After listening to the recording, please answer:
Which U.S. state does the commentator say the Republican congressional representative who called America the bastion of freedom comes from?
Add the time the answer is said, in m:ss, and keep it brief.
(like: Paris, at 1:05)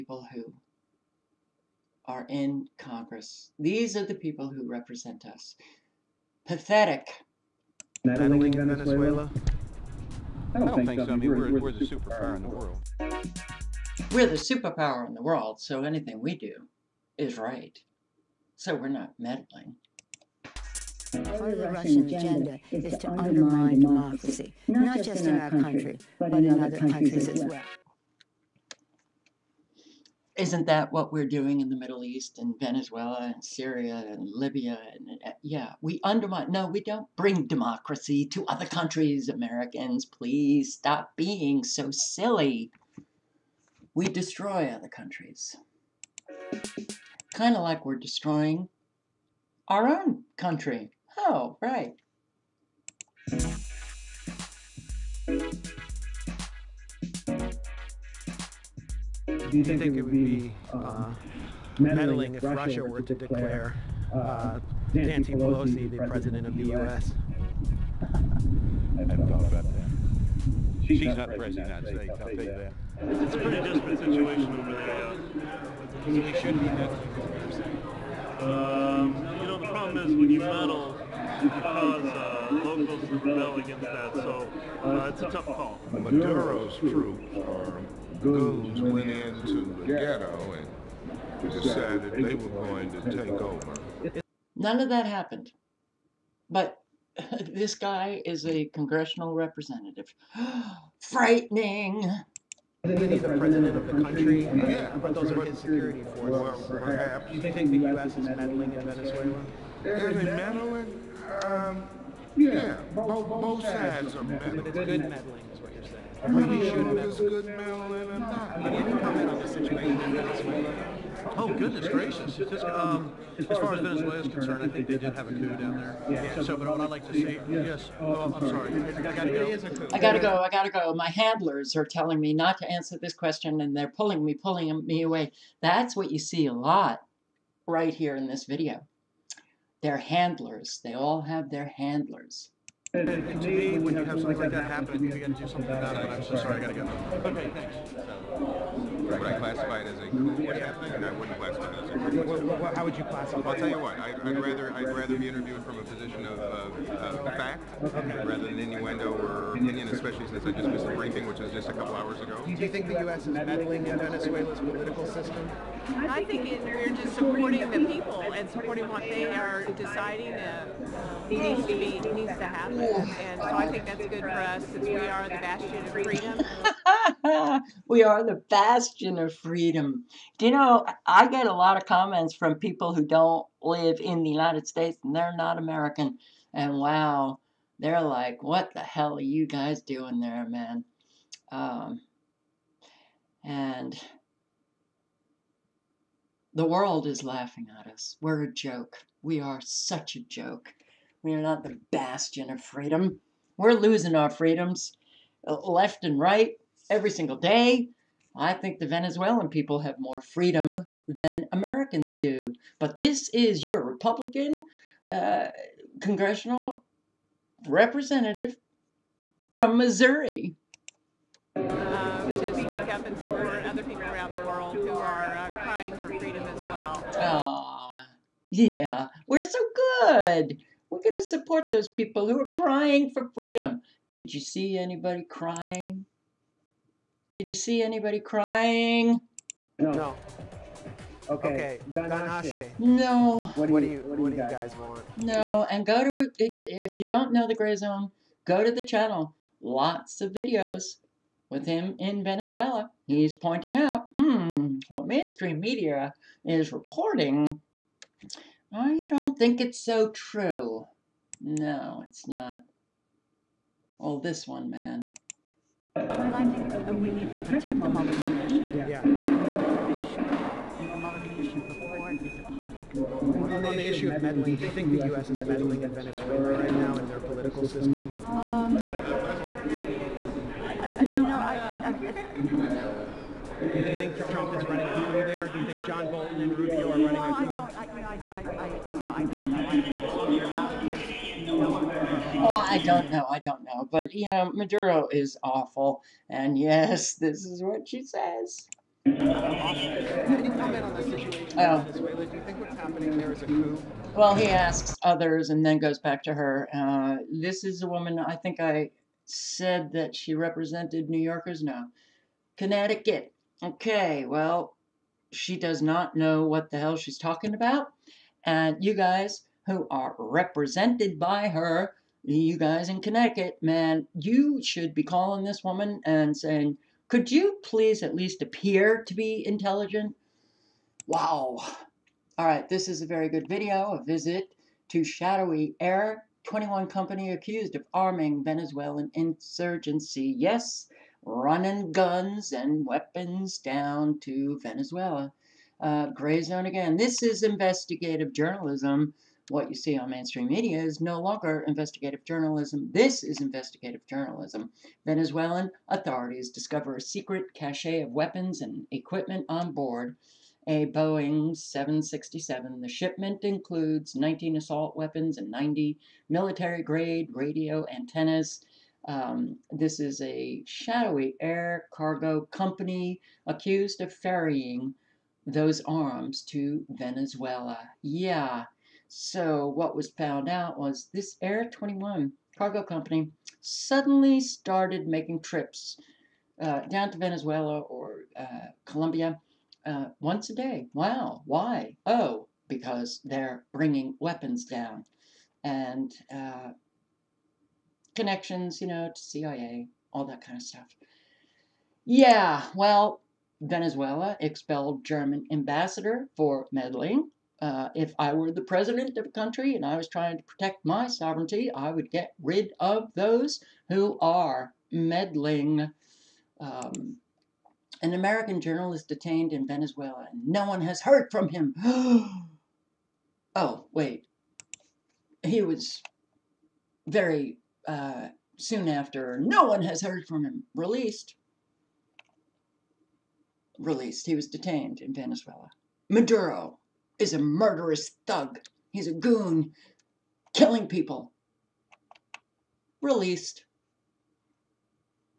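Missouri, at 3:39.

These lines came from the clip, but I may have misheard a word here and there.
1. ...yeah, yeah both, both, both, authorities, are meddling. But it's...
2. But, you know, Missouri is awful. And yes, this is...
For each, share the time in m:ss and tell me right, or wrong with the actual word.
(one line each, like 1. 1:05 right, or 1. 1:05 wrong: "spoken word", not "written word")
1. 1:52 wrong: "sides", not "authorities"
2. 4:53 wrong: "Maduro", not "Missouri".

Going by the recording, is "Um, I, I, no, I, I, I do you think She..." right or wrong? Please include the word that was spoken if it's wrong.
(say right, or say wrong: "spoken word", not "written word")
wrong: "Trump", not "She".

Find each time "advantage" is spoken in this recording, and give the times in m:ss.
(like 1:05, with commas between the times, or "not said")
not said.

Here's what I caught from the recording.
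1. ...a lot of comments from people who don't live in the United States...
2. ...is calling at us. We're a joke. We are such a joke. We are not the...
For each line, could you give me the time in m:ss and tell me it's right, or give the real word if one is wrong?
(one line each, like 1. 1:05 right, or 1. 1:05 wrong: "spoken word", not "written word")
1. 3:01 right
2. 3:17 wrong: "laughing", not "calling".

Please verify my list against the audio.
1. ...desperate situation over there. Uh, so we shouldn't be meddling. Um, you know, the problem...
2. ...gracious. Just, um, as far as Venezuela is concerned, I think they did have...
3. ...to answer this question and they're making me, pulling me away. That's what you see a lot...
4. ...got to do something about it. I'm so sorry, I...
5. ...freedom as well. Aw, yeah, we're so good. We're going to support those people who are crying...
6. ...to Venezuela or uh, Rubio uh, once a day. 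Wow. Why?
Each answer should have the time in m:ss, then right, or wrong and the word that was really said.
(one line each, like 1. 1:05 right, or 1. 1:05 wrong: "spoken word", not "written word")
1. 1:13 right
2. 2:01 right
3. 2:12 wrong: "pulling", not "making"
4. 2:25 right
5. 3:46 right
6. 6:27 wrong: "Colombia", not "Rubio".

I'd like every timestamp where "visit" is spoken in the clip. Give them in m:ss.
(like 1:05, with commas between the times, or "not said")
5:34.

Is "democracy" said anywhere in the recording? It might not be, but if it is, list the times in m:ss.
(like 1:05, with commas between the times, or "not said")
0:23, 0:37.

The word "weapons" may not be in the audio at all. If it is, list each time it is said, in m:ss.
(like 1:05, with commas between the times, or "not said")
5:42, 5:58, 6:04, 6:34.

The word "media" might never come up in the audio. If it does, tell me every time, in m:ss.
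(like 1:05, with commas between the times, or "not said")
4:15, 5:50.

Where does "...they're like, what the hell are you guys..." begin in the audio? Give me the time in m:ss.
3:07.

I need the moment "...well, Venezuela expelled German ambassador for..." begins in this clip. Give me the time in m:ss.
6:42.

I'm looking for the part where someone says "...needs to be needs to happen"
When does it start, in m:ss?
2:51.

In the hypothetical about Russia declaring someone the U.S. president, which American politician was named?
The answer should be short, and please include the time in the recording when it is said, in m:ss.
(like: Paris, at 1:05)
Nancy Pelosi, at 1:04.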